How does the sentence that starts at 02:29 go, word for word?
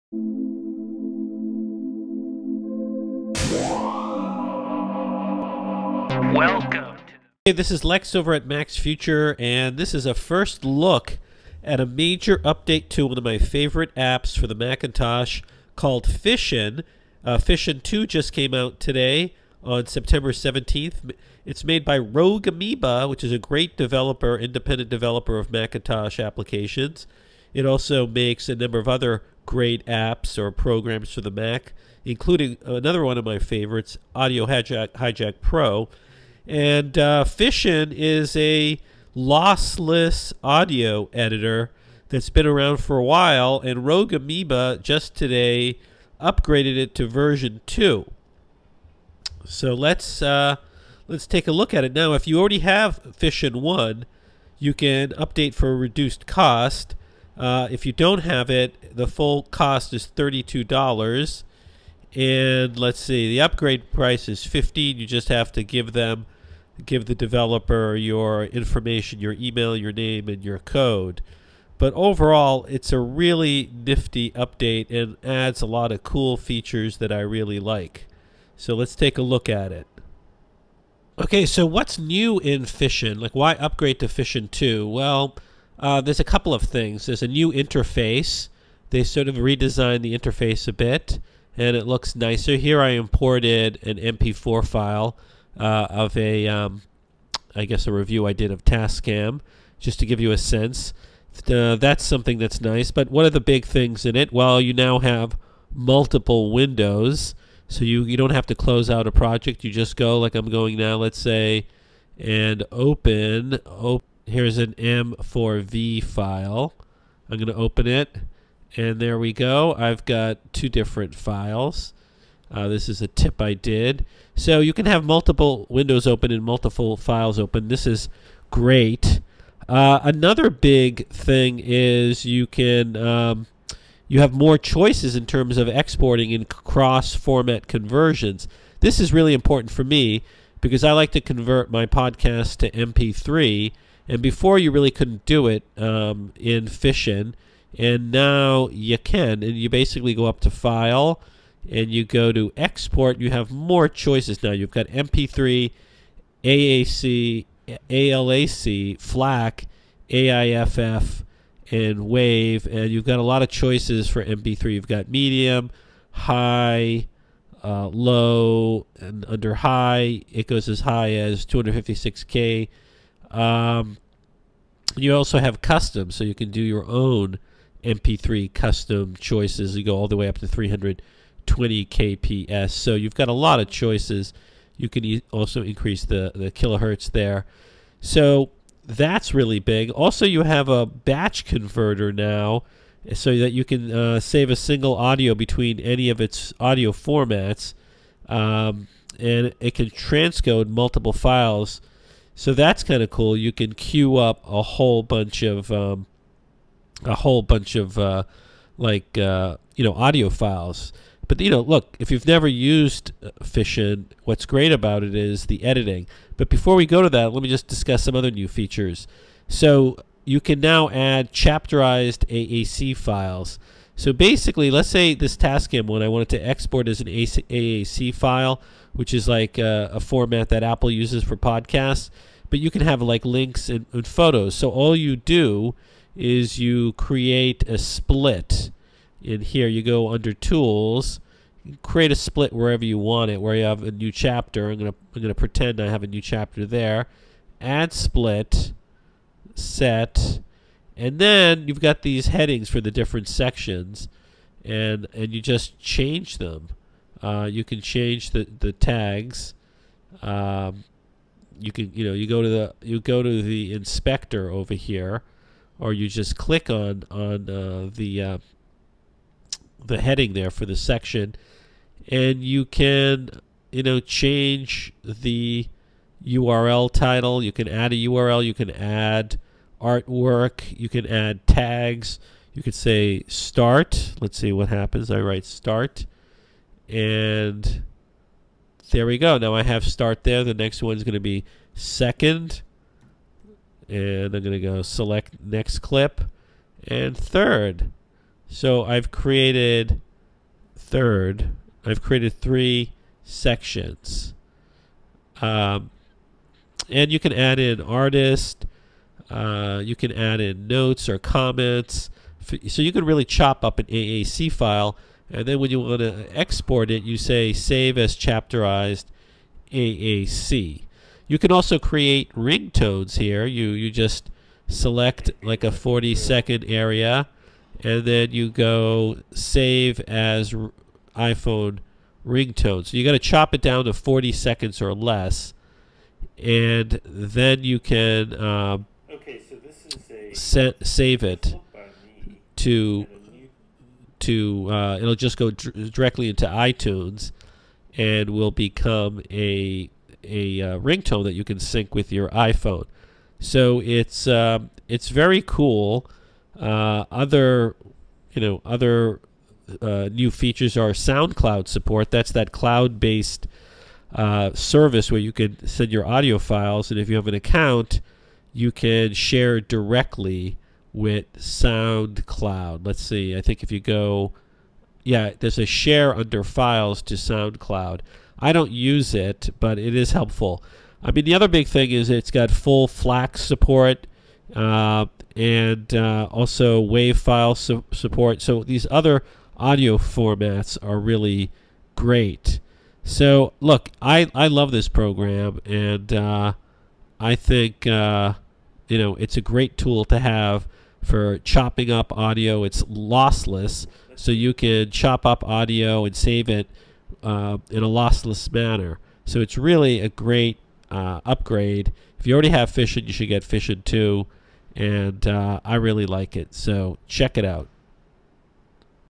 And you basically go up to File, and you go to Export.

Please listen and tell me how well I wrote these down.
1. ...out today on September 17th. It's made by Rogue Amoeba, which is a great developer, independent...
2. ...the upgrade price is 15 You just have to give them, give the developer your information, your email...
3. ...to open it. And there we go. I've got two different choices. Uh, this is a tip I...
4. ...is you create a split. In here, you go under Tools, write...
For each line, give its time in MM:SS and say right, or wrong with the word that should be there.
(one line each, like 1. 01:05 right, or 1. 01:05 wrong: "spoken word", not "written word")
1. 00:18 right
2. 01:03 right
3. 01:57 wrong: "files", not "choices"
4. 03:56 wrong: "create", not "write".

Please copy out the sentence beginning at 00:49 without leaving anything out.
So let's uh, let's take a look at it now.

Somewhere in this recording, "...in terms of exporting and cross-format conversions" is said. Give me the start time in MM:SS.
02:15.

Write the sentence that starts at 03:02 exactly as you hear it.
So you've got a lot of choices.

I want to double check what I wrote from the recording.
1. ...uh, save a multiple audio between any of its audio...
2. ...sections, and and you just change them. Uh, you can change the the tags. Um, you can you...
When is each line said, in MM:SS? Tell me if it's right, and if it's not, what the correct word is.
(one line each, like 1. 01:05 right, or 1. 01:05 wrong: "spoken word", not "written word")
1. 03:13 wrong: "single", not "multiple"
2. 04:13 right.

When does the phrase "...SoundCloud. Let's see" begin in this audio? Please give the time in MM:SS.
06:11.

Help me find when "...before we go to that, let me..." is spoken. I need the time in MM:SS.
03:36.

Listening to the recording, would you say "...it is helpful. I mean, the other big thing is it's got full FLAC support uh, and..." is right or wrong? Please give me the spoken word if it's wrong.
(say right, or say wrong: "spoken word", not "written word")
right.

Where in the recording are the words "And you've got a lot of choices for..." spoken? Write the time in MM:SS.
02:42.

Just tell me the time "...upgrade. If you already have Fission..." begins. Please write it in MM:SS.
06:51.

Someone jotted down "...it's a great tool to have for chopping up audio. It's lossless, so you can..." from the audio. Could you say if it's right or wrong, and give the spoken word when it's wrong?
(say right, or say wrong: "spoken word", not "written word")
right.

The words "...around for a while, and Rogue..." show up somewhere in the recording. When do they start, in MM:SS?
00:42.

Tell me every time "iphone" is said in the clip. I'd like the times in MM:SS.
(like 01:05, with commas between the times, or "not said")
05:31, 05:52.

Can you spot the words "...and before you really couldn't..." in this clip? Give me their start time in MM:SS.
02:24.